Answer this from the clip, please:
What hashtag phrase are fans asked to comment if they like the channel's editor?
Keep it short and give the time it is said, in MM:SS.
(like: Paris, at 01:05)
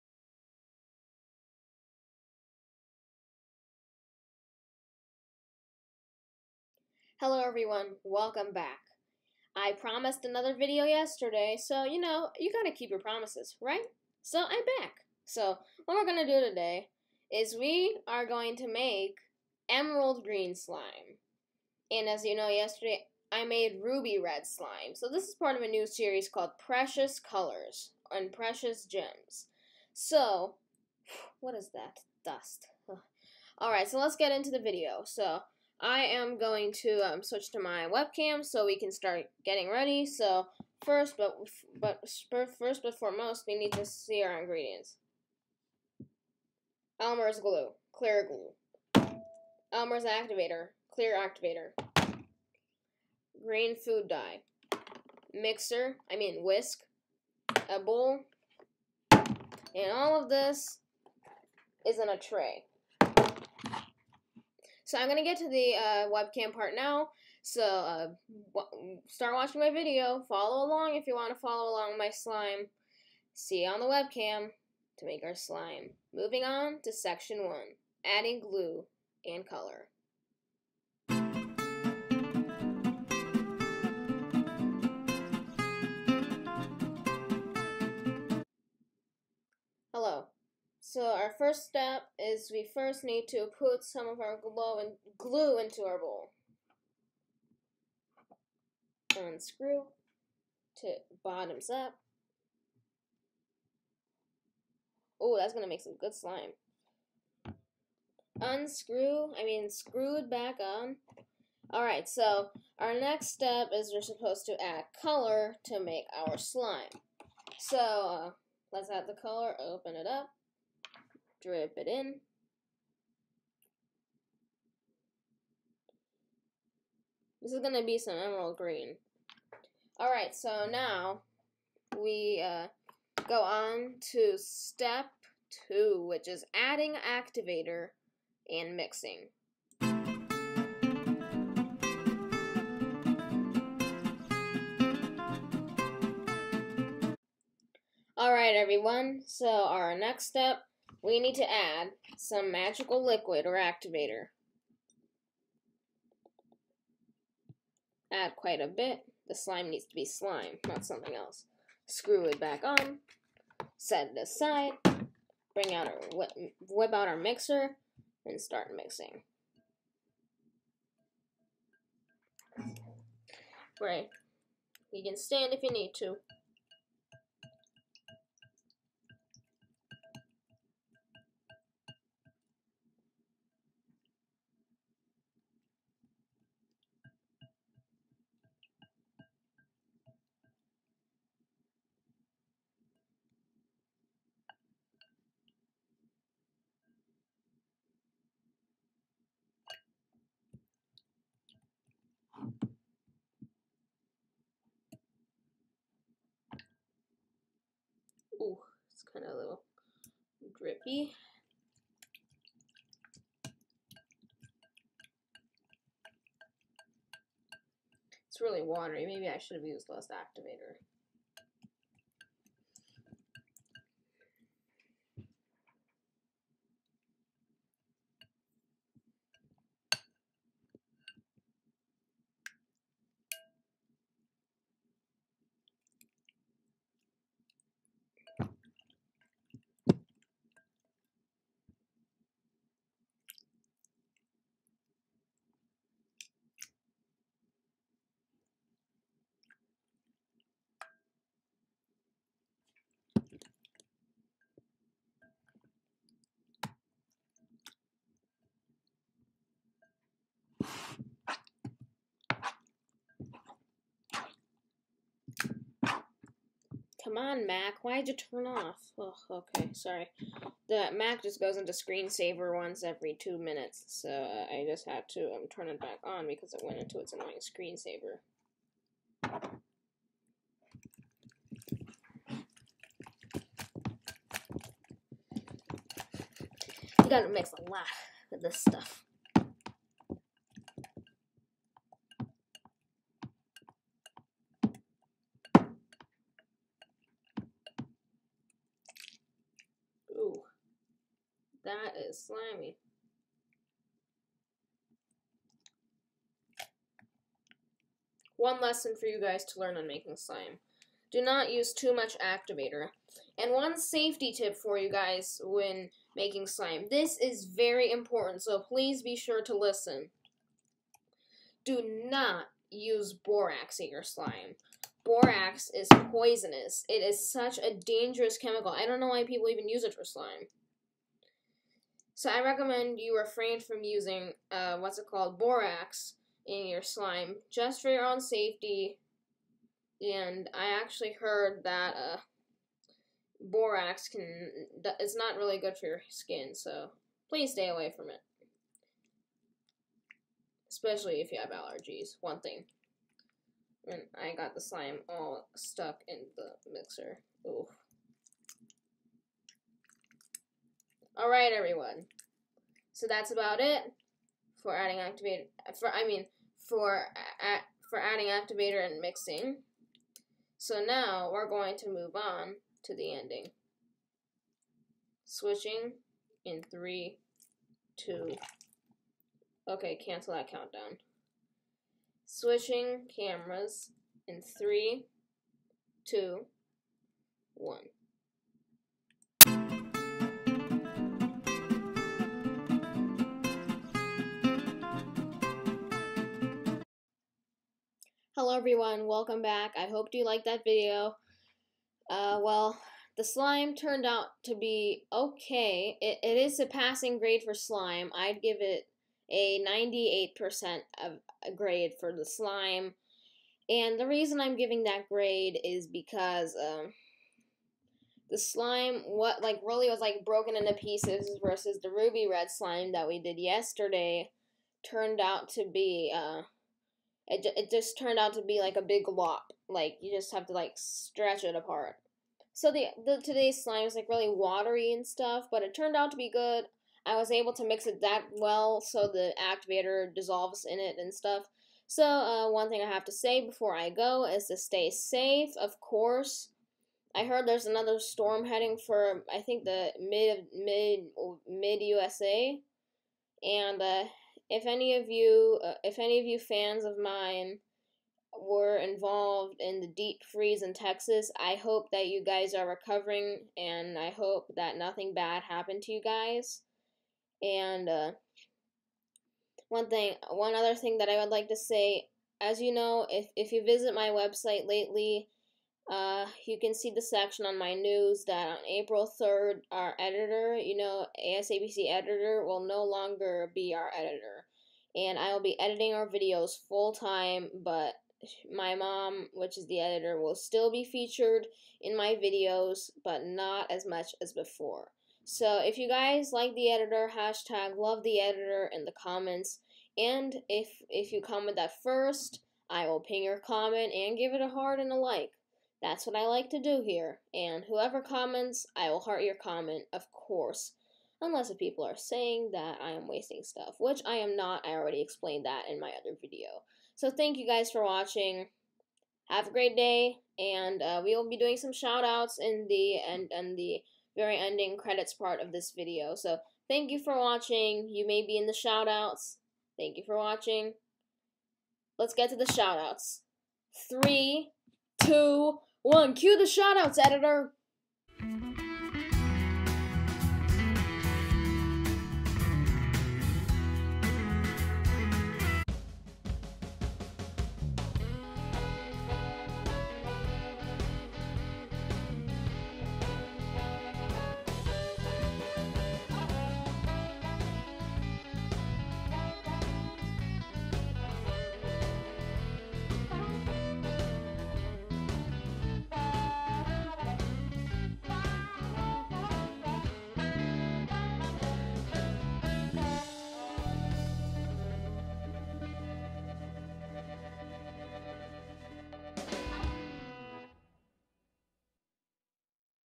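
love the editor, at 08:17.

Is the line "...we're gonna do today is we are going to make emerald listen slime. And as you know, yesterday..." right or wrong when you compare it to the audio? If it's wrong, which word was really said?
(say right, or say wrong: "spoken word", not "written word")
wrong: "green", not "listen".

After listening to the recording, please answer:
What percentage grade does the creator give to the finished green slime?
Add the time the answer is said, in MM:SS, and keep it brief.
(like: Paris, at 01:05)
98%, at 06:49.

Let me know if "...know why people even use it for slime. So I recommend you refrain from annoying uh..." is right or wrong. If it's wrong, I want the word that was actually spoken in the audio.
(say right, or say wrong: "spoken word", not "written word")
wrong: "using", not "annoying".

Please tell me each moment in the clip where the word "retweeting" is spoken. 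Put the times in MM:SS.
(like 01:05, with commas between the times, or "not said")
not said.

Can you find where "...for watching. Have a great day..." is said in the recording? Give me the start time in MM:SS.
08:37.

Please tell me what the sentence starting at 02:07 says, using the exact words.
This is going to be some emerald green.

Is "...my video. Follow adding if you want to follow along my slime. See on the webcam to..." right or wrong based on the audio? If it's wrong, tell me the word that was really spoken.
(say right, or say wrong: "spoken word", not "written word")
wrong: "along", not "adding".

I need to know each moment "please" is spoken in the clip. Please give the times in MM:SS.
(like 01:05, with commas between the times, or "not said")
05:18, 05:47.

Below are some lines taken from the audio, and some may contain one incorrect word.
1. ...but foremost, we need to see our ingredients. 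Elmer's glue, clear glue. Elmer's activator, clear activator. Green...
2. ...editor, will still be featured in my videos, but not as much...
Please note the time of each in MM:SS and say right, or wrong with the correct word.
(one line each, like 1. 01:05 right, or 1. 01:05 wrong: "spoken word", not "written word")
1. 00:42 right
2. 08:09 right.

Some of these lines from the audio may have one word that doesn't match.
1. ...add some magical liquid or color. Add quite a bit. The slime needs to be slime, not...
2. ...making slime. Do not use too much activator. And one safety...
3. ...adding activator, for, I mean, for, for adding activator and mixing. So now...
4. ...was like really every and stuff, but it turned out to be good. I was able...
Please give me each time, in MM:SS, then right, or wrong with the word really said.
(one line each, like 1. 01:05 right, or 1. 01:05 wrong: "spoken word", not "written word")
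1. 02:31 wrong: "activator", not "color"
2. 05:09 right
3. 06:04 right
4. 07:13 wrong: "watery", not "every".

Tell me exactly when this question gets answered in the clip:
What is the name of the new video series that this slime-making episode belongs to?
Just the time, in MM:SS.
00:26.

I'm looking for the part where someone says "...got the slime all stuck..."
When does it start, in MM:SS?
05:54.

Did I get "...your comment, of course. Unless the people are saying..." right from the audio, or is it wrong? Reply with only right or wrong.
right.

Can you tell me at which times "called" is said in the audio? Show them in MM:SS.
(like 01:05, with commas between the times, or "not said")
00:26, 05:35.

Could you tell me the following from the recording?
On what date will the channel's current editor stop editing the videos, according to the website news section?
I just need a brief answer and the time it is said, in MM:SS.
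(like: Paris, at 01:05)
April 3rd, at 07:58.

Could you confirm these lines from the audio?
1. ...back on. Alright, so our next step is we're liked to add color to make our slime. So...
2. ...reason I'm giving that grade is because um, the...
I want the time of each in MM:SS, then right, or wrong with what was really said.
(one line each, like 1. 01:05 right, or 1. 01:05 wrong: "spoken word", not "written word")
1. 01:50 wrong: "supposed", not "liked"
2. 06:54 right.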